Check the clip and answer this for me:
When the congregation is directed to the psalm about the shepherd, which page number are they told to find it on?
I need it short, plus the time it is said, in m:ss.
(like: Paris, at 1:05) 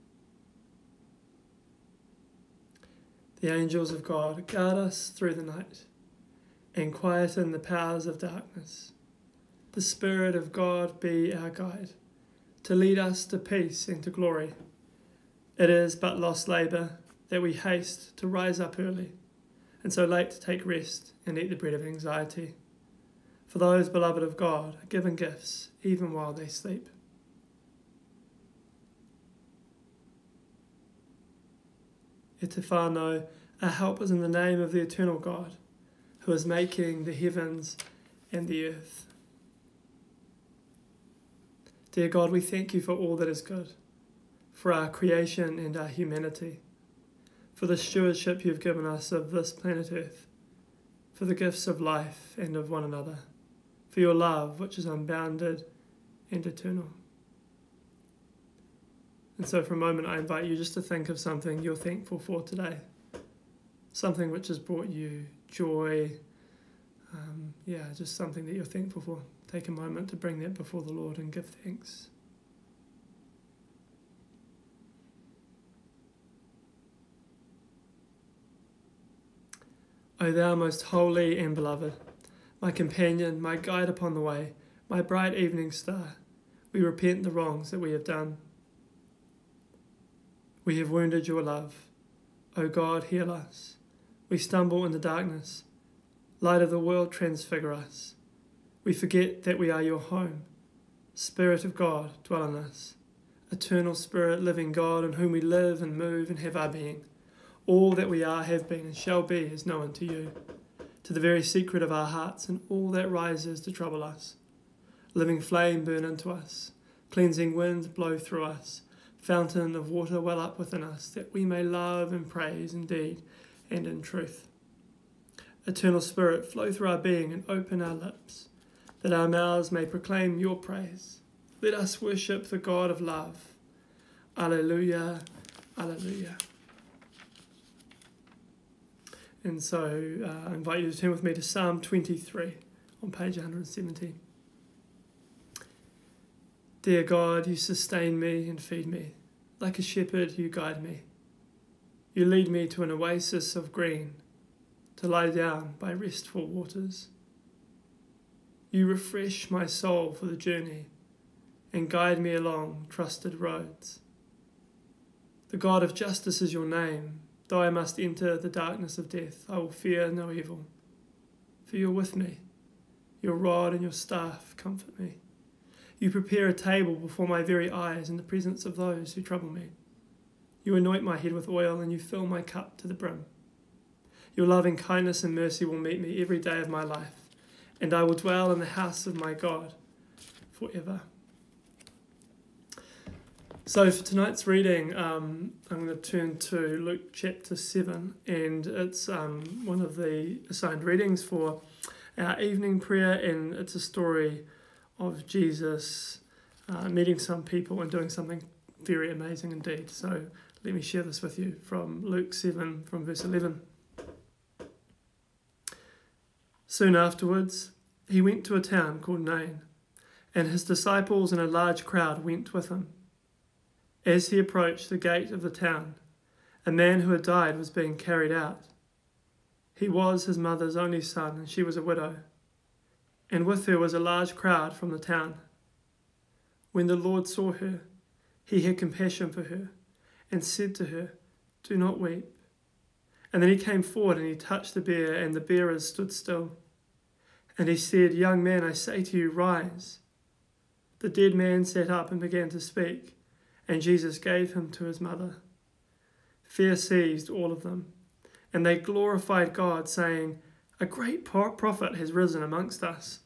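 170, at 2:23.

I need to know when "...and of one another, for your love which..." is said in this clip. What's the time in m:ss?
0:52.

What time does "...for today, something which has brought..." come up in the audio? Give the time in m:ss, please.
1:02.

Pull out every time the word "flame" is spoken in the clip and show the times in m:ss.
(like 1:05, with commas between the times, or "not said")
1:55.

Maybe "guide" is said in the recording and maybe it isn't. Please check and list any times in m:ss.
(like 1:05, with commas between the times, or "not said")
0:11, 1:23, 2:30, 2:41.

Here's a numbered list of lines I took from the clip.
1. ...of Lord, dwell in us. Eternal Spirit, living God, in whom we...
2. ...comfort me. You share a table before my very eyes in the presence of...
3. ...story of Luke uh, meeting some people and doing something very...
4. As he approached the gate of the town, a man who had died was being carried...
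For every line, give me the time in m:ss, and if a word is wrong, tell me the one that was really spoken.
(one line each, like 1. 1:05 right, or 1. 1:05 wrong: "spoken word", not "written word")
1. 1:41 wrong: "God", not "Lord"
2. 2:54 wrong: "prepare", not "share"
3. 3:23 wrong: "Jesus", not "Luke"
4. 3:44 right.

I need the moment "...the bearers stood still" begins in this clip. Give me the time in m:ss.
4:05.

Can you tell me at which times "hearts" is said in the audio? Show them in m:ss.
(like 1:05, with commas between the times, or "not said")
1:52.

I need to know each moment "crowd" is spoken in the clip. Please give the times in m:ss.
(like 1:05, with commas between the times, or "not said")
3:41, 3:54.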